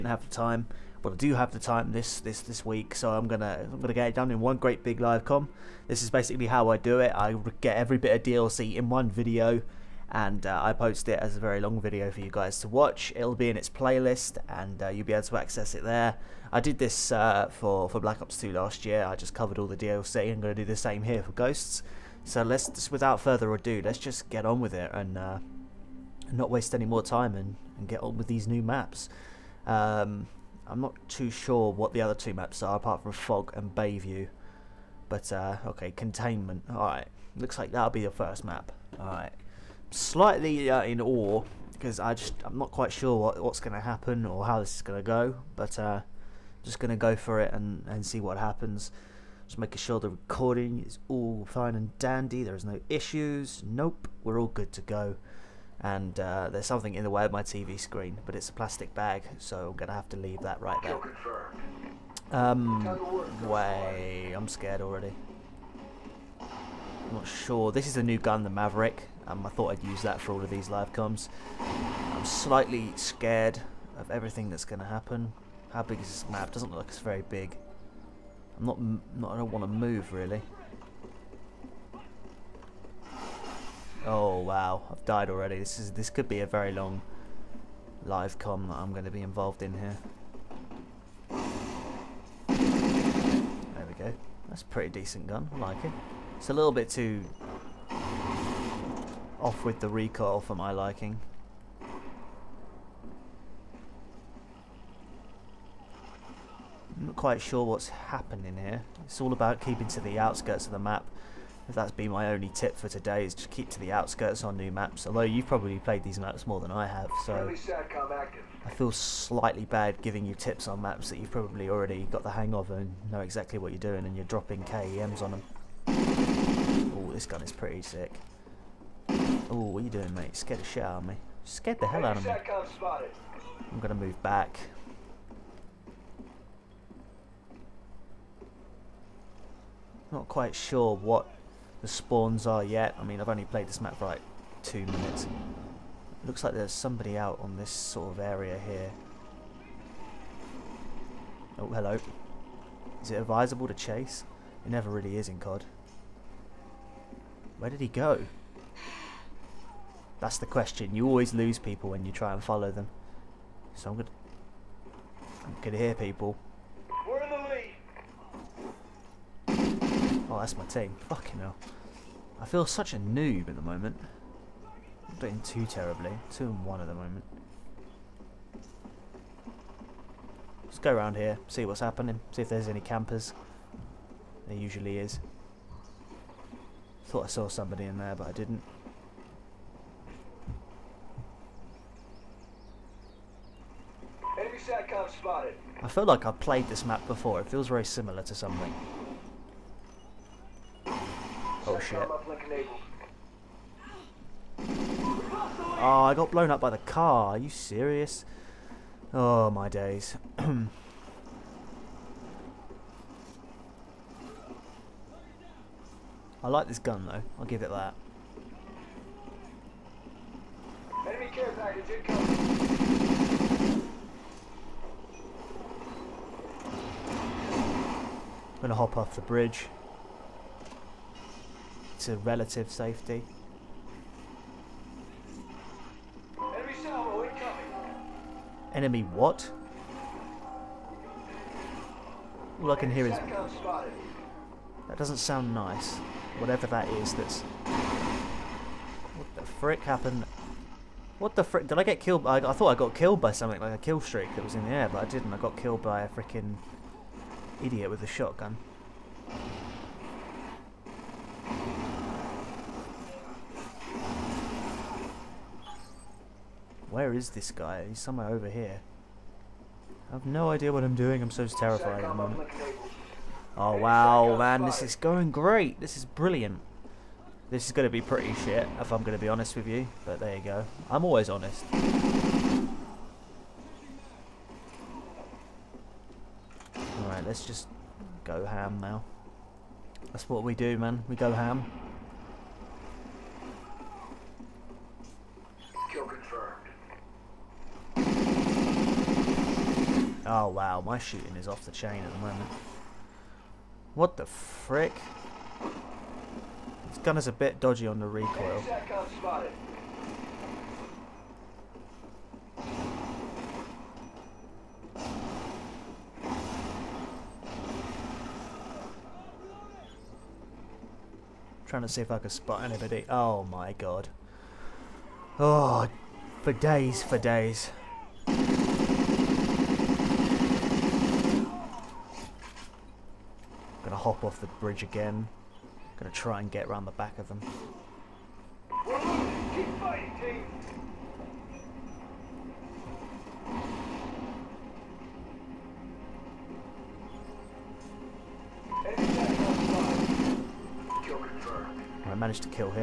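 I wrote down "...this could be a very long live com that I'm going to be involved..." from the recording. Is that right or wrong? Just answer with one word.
right.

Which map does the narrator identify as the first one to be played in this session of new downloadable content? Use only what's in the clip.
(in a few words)
Containment.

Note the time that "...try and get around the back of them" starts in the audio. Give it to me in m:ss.
5:36.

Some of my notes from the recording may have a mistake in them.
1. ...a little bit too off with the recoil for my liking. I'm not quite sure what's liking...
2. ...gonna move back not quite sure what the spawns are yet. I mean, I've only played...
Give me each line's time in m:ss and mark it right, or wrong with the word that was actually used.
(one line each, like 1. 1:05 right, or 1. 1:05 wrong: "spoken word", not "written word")
1. 1:36 wrong: "happening", not "liking"
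2. 2:13 right.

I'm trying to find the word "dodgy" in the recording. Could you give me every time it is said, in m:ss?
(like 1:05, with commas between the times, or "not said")
5:07.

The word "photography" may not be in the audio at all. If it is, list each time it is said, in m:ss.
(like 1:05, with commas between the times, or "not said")
not said.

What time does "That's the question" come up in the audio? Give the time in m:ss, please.
2:40.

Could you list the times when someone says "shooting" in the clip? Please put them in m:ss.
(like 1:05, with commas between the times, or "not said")
5:00.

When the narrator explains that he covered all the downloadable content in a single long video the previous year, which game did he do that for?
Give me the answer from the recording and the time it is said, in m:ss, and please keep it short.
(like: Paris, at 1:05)
Black Ops 2, at 0:17.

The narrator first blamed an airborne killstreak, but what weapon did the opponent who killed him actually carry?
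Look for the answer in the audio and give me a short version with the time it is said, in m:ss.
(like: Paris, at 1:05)
A shotgun, at 4:18.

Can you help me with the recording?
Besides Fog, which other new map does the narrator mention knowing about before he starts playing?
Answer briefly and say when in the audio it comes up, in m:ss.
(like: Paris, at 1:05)
Bayview, at 0:33.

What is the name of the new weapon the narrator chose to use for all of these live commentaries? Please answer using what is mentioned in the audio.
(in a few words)
Maverick.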